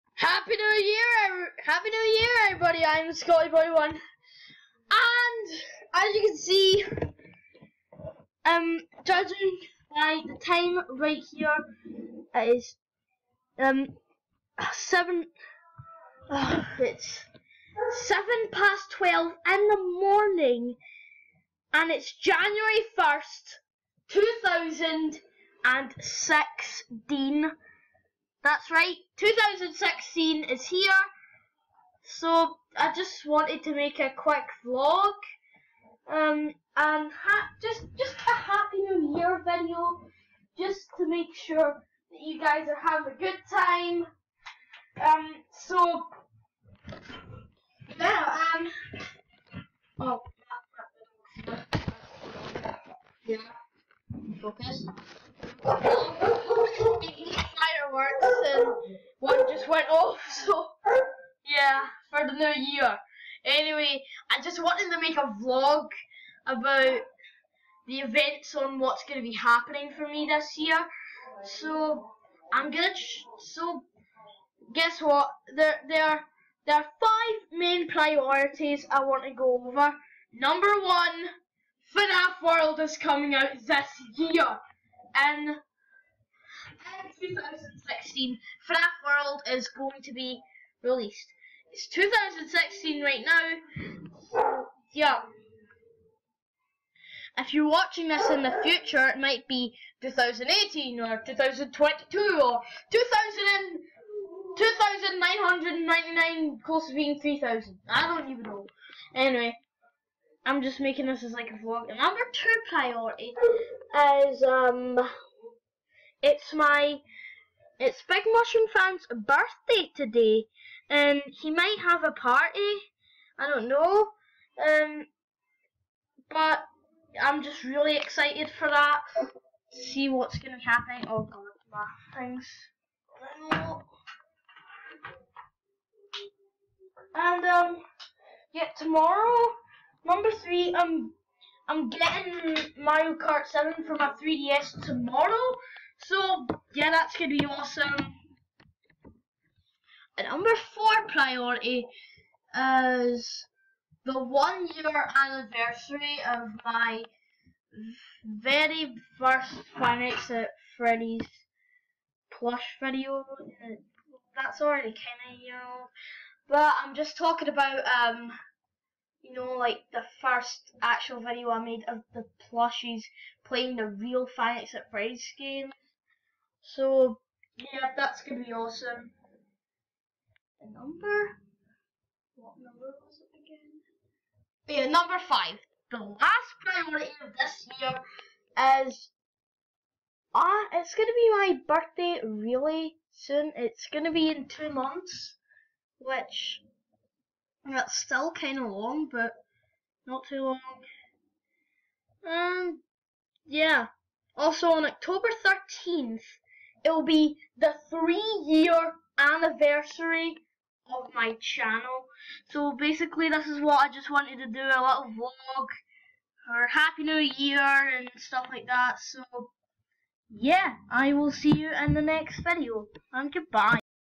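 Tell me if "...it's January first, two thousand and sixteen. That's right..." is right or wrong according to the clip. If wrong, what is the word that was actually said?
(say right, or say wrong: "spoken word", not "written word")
right.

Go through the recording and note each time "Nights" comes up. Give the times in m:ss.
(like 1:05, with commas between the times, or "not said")
2:39, 2:54.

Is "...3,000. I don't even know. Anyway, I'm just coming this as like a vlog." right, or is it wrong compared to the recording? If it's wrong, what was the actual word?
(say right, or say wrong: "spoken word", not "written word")
wrong: "making", not "coming".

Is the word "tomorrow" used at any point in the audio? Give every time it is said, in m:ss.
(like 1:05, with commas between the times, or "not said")
2:18, 2:24.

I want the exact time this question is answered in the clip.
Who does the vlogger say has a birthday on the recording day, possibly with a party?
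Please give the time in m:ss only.
1:58.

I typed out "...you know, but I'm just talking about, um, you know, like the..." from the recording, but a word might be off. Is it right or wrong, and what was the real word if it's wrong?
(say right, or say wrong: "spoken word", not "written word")
right.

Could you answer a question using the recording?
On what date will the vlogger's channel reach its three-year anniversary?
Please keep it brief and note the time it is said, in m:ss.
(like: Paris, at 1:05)
October 13th, at 3:24.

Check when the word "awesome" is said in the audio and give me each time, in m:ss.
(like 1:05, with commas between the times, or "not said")
2:27, 2:58.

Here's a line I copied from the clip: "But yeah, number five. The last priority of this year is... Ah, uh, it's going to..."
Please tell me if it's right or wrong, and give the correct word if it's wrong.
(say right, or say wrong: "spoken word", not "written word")
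right.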